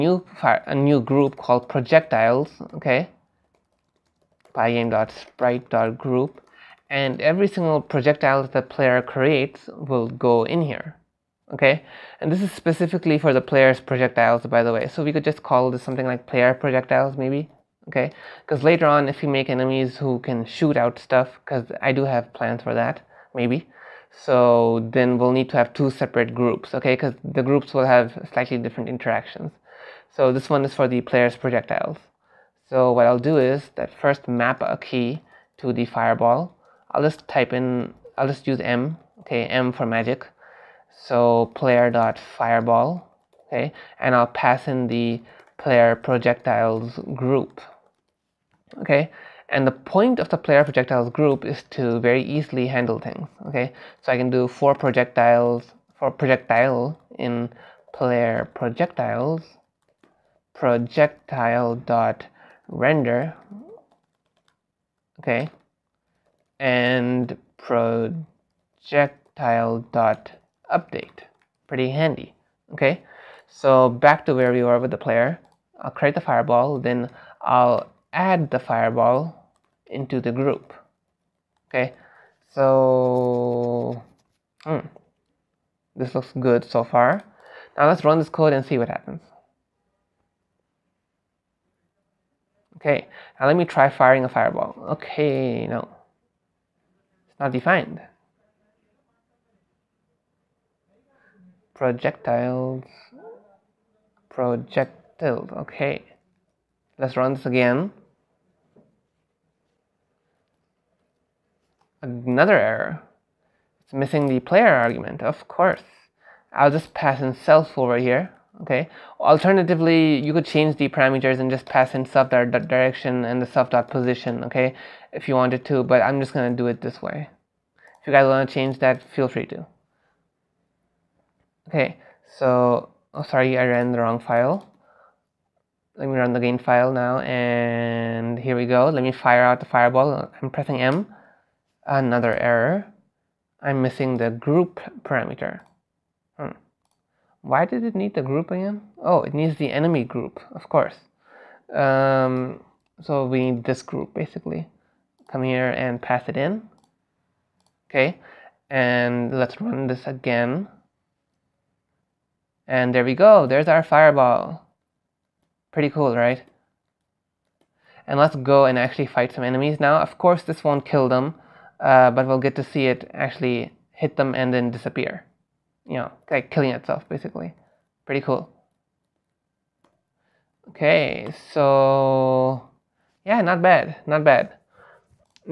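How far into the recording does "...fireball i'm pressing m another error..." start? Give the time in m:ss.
2:19.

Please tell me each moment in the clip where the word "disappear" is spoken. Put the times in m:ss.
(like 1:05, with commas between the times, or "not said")
2:54.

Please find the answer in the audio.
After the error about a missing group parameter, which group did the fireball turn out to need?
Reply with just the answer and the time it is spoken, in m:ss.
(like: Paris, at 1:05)
enemy group, at 2:29.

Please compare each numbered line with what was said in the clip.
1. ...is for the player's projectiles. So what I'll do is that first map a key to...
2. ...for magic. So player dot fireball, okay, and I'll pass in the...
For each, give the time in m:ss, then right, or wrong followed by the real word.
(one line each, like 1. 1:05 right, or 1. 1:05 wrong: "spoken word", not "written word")
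1. 0:30 right
2. 0:39 right.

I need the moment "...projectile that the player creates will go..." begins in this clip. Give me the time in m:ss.
0:07.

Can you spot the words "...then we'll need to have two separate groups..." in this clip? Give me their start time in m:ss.
0:24.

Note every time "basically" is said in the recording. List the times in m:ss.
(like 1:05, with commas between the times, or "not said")
2:34, 2:57.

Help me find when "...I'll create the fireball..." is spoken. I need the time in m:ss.
1:15.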